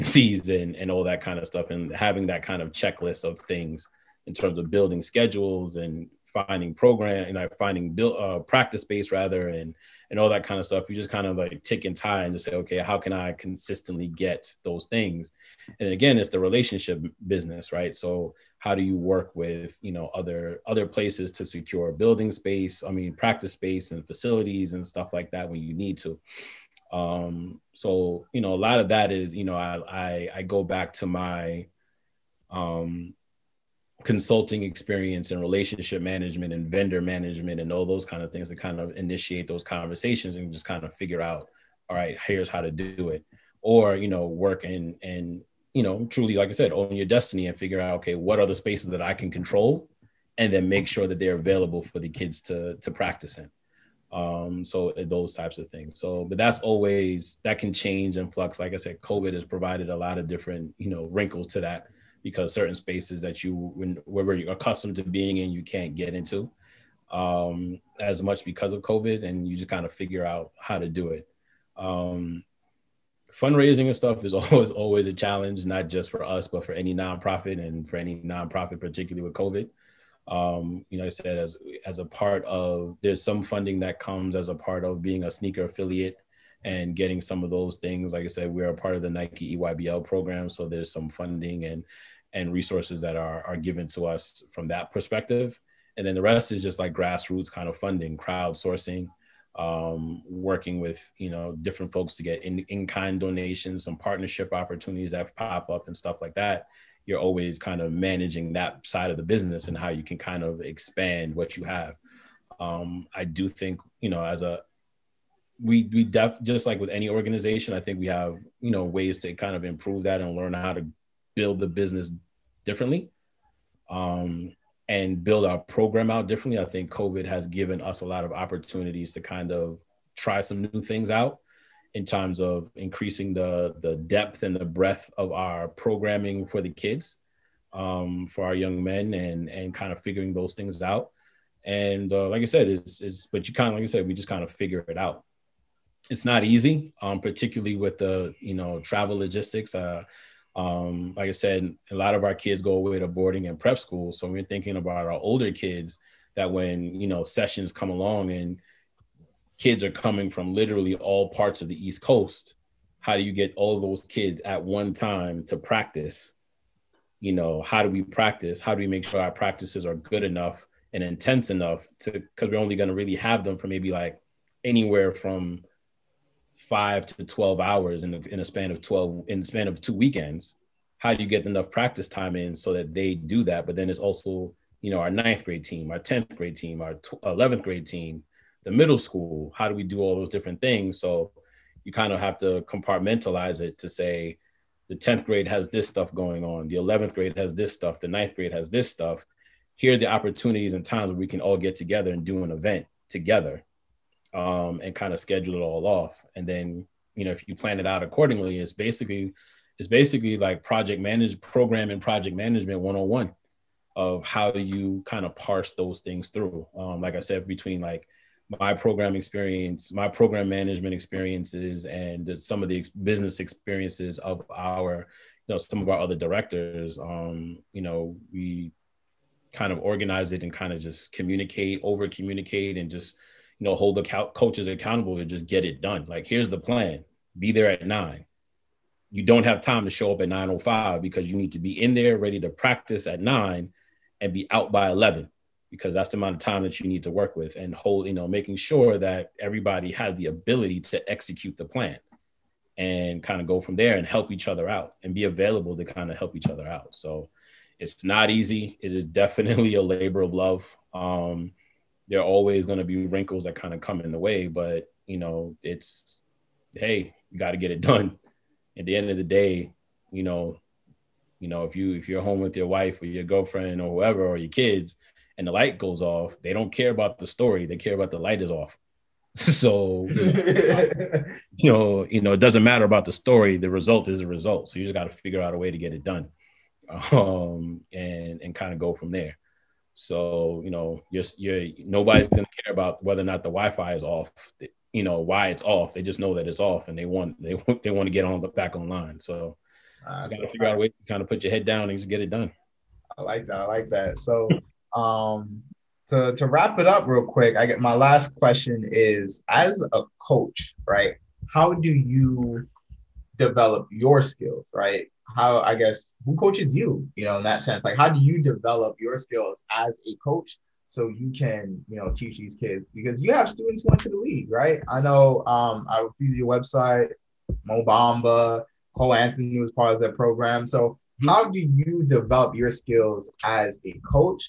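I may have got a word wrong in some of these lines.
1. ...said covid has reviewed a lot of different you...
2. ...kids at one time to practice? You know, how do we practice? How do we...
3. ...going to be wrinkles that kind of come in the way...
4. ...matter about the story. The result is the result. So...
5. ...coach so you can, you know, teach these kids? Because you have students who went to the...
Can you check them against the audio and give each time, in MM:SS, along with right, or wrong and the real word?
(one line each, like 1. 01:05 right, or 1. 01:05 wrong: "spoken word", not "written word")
1. 00:58 wrong: "provided", not "reviewed"
2. 02:44 right
3. 04:22 right
4. 04:42 right
5. 05:20 right.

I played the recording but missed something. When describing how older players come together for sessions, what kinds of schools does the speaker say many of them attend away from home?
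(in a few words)
boarding and prep school.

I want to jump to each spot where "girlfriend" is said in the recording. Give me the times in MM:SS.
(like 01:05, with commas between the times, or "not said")
04:33.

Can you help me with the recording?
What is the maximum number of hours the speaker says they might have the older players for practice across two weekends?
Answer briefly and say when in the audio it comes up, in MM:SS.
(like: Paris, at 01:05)
12, at 02:57.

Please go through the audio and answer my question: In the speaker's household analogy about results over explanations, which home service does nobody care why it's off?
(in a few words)
Wi-Fi.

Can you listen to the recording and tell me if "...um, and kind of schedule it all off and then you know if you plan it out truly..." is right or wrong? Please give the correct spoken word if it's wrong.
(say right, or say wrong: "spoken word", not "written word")
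wrong: "accordingly", not "truly".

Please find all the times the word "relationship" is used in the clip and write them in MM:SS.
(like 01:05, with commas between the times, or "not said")
00:16, 00:35.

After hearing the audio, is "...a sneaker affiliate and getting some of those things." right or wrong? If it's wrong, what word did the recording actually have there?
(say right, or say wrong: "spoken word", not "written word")
right.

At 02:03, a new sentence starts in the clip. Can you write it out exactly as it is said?
Um, and build our program out differently.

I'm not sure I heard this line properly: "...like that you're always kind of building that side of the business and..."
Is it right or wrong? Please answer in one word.
wrong.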